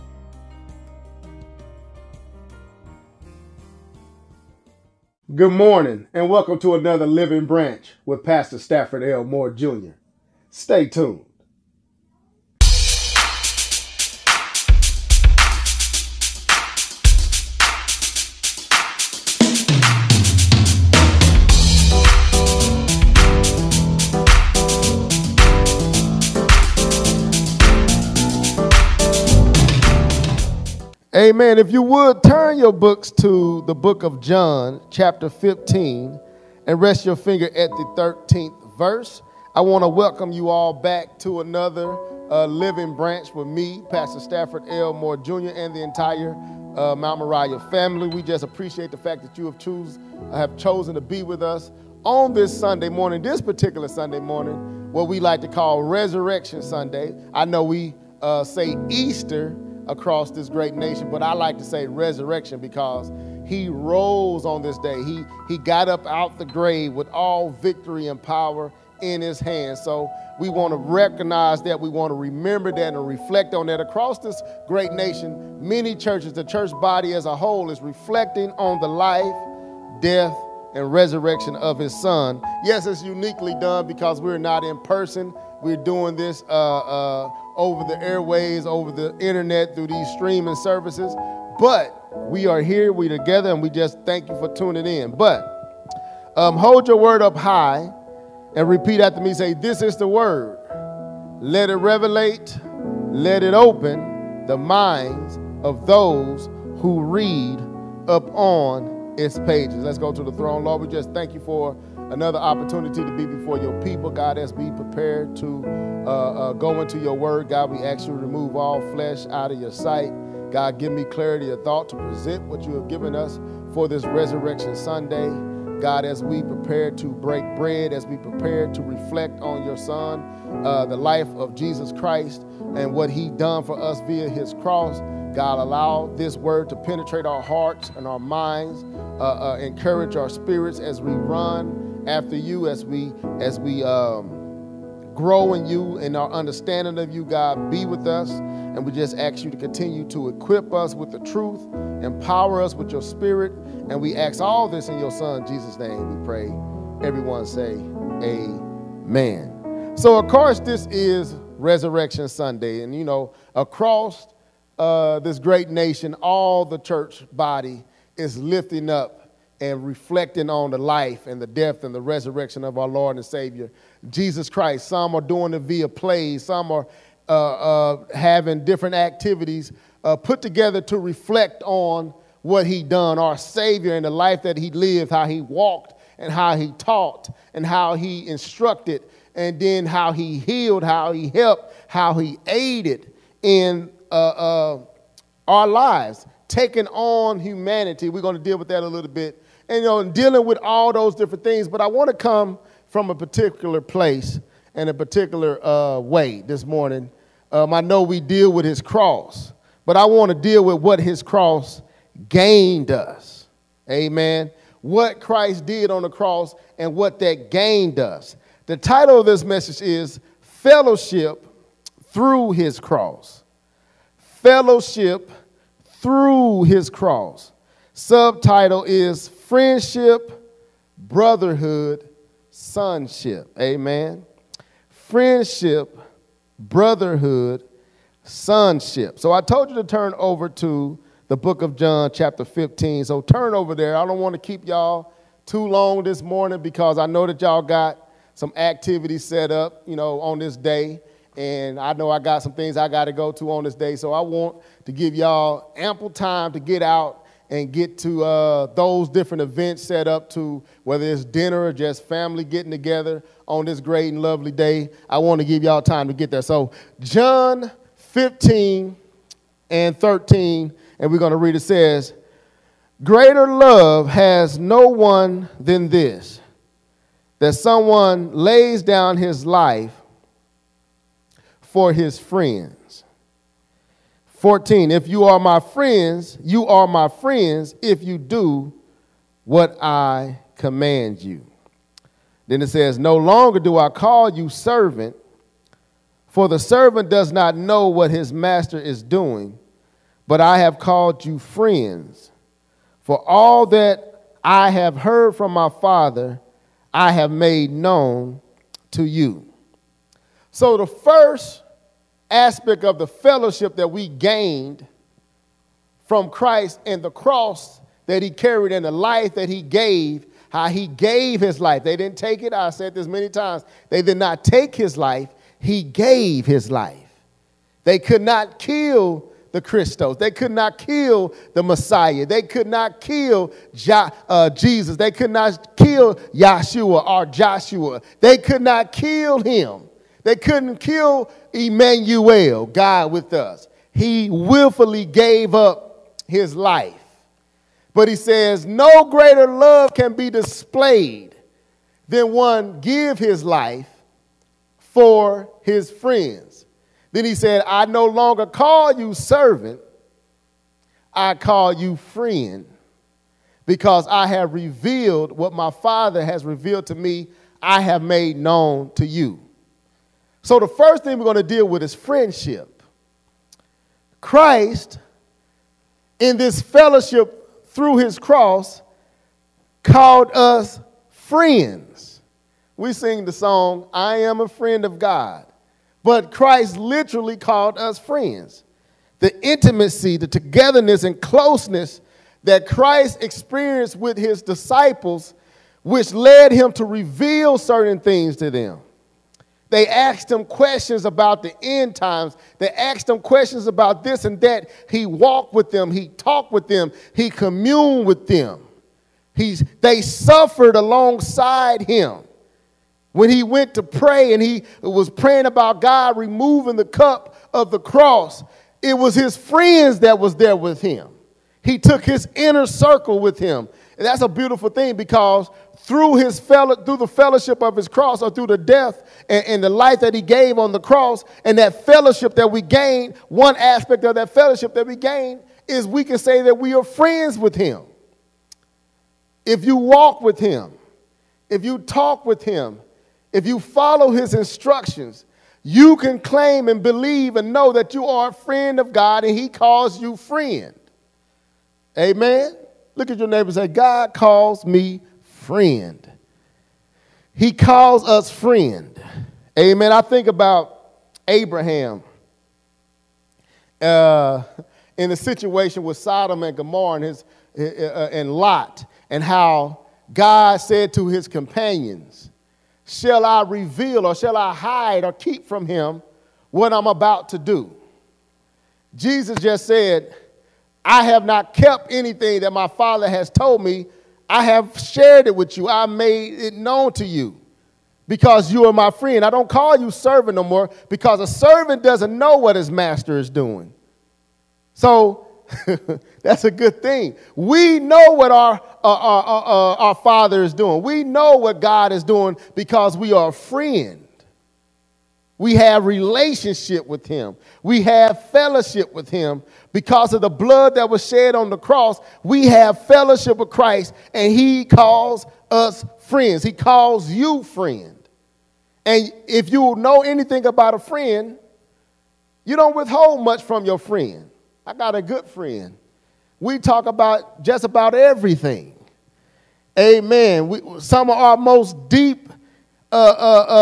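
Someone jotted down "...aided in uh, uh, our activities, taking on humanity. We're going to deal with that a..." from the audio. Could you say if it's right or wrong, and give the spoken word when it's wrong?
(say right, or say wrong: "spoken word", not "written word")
wrong: "lives", not "activities".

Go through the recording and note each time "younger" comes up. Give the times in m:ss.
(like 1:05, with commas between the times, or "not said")
not said.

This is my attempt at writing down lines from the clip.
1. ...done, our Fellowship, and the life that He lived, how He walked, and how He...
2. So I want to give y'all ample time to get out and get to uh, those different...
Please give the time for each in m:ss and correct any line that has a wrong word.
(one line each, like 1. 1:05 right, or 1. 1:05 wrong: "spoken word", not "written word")
1. 3:02 wrong: "Savior", not "Fellowship"
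2. 4:13 right.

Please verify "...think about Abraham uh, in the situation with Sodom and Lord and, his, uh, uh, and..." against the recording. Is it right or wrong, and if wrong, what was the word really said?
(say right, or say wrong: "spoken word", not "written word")
wrong: "Gomorrah", not "Lord".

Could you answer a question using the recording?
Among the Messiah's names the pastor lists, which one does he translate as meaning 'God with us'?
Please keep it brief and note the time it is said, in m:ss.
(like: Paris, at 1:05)
Emmanuel, at 5:41.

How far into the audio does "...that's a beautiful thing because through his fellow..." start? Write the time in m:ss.
7:04.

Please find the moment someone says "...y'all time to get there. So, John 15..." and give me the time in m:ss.
4:25.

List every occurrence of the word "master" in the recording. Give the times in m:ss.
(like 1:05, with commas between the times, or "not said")
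4:58, 8:12.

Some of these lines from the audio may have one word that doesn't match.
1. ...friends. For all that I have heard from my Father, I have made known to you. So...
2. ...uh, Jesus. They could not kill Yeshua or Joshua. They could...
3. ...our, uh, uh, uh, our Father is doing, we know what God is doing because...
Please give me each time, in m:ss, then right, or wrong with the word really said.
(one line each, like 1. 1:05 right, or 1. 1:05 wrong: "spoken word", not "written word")
1. 5:01 right
2. 5:34 right
3. 8:18 right.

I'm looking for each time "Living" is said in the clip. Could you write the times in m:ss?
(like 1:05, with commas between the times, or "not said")
0:07, 0:42.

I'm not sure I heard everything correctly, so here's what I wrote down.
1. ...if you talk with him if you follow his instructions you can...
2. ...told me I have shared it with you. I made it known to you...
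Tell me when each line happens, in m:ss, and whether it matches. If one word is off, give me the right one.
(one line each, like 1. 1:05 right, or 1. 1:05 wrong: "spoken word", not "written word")
1. 7:21 right
2. 8:03 right.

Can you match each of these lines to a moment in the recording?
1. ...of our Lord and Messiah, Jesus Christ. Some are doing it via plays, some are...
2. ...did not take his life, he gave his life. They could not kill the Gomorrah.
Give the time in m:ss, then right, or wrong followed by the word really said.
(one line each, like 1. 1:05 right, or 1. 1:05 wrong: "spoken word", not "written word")
1. 2:52 wrong: "Savior", not "Messiah"
2. 5:24 wrong: "Christos", not "Gomorrah".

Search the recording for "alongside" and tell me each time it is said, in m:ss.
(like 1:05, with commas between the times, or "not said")
6:50.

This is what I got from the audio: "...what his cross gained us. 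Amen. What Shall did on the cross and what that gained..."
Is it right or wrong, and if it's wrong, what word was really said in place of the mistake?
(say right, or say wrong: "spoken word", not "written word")
wrong: "Christ", not "Shall".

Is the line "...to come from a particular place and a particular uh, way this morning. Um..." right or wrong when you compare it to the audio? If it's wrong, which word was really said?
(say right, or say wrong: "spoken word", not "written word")
right.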